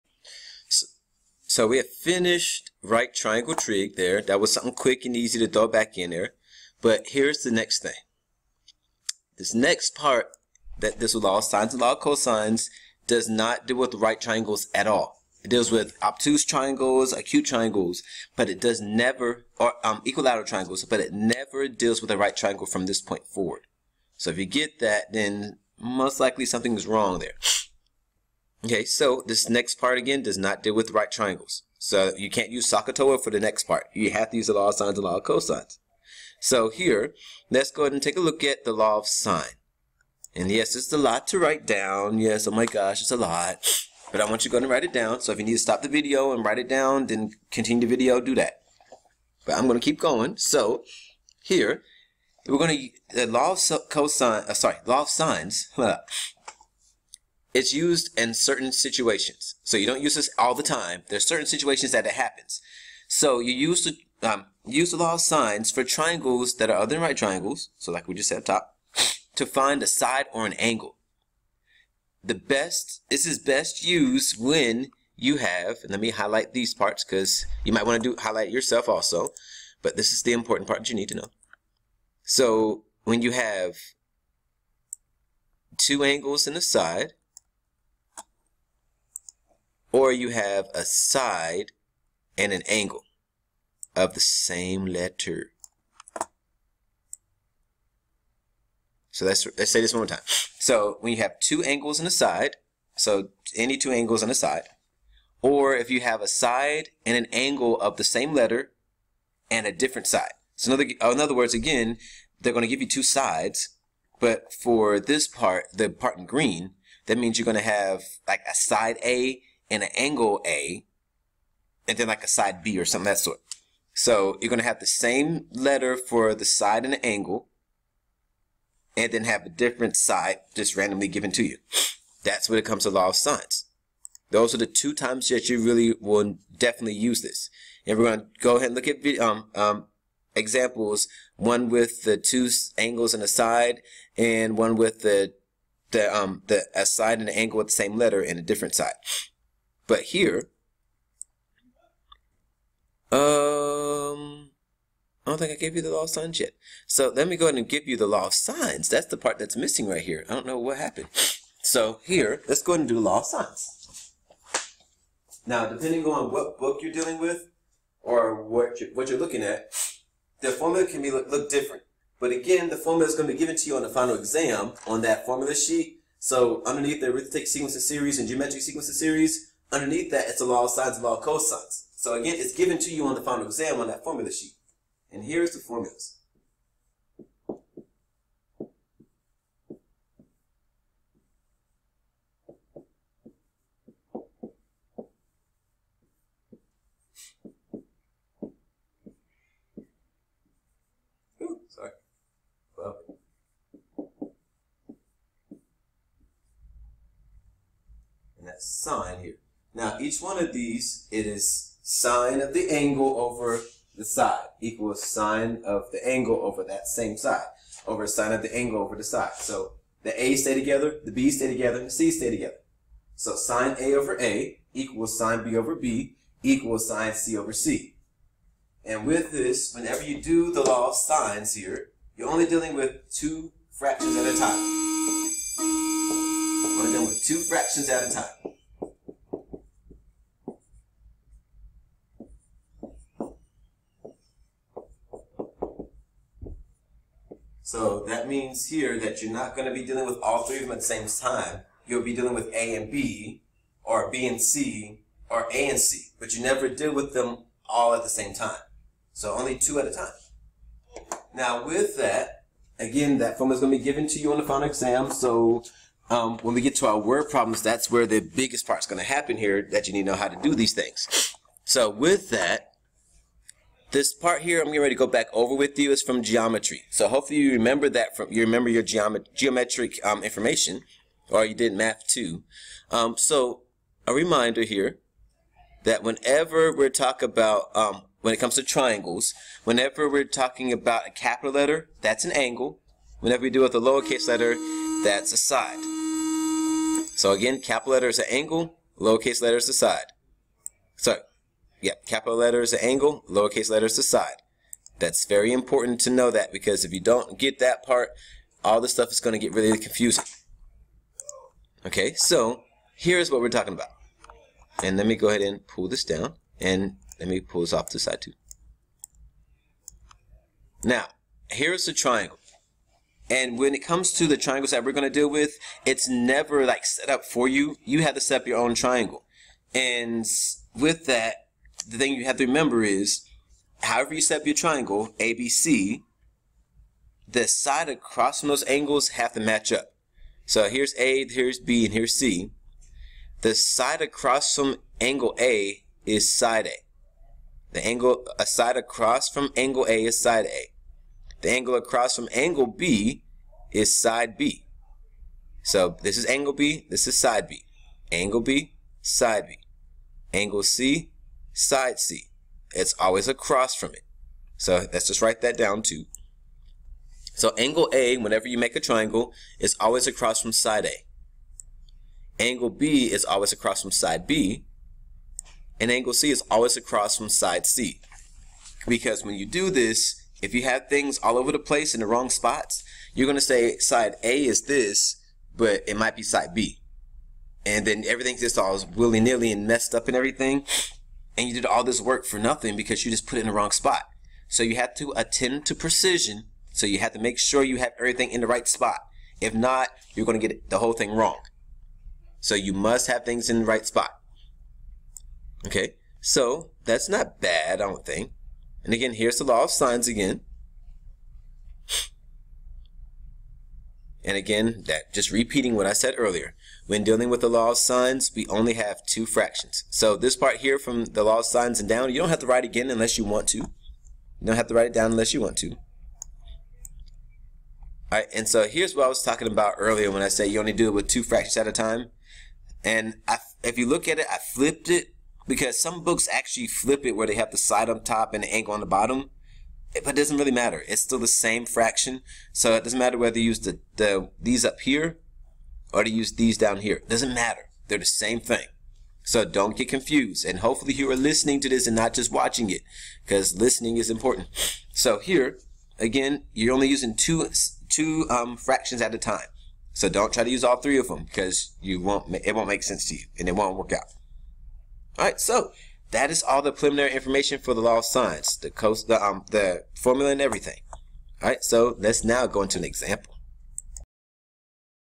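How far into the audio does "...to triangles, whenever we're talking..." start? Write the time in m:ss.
4:48.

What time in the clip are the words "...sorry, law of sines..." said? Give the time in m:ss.
0:54.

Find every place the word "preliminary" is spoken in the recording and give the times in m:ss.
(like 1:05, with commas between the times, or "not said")
7:46.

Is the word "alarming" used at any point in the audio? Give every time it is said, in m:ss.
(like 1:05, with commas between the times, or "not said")
not said.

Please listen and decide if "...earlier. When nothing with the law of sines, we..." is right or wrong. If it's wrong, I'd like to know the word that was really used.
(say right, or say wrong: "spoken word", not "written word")
wrong: "dealing", not "nothing".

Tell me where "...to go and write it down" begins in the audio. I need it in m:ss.
0:44.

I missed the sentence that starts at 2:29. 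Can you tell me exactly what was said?
But here, um, I don't think I gave you the law of sines yet.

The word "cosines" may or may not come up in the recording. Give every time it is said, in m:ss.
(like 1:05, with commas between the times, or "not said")
0:11, 0:35, 0:53, 3:01.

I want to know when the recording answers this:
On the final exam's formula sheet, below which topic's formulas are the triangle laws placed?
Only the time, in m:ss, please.
2:57.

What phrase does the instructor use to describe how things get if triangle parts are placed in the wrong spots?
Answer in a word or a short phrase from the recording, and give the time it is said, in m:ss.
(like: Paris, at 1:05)
willy-nilly, at 6:28.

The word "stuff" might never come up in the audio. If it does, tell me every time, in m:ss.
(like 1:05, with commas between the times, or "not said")
5:08.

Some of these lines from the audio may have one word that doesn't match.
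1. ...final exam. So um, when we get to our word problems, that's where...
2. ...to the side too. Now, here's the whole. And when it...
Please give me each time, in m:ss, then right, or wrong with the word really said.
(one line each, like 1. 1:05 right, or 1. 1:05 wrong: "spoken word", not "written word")
1. 4:24 right
2. 5:17 wrong: "triangle", not "whole".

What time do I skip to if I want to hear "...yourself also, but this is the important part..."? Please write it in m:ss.
1:18.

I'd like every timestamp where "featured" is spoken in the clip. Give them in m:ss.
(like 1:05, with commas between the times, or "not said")
not said.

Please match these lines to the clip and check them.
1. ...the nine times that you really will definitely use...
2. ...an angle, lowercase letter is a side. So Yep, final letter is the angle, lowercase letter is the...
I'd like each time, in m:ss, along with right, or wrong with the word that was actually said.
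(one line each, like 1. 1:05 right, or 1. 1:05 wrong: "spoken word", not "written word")
1. 2:14 wrong: "two", not "nine"
2. 4:58 wrong: "capital", not "final".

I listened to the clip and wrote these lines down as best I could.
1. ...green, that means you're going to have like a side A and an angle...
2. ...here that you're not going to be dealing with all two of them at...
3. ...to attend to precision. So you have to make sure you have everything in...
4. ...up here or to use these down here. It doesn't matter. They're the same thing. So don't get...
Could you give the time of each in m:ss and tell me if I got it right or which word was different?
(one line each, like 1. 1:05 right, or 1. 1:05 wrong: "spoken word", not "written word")
1. 1:56 right
2. 4:08 wrong: "three", not "two"
3. 6:34 right
4. 7:24 right.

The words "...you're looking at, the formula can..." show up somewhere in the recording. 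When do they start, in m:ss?
2:49.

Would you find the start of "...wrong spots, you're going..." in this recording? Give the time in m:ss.
6:22.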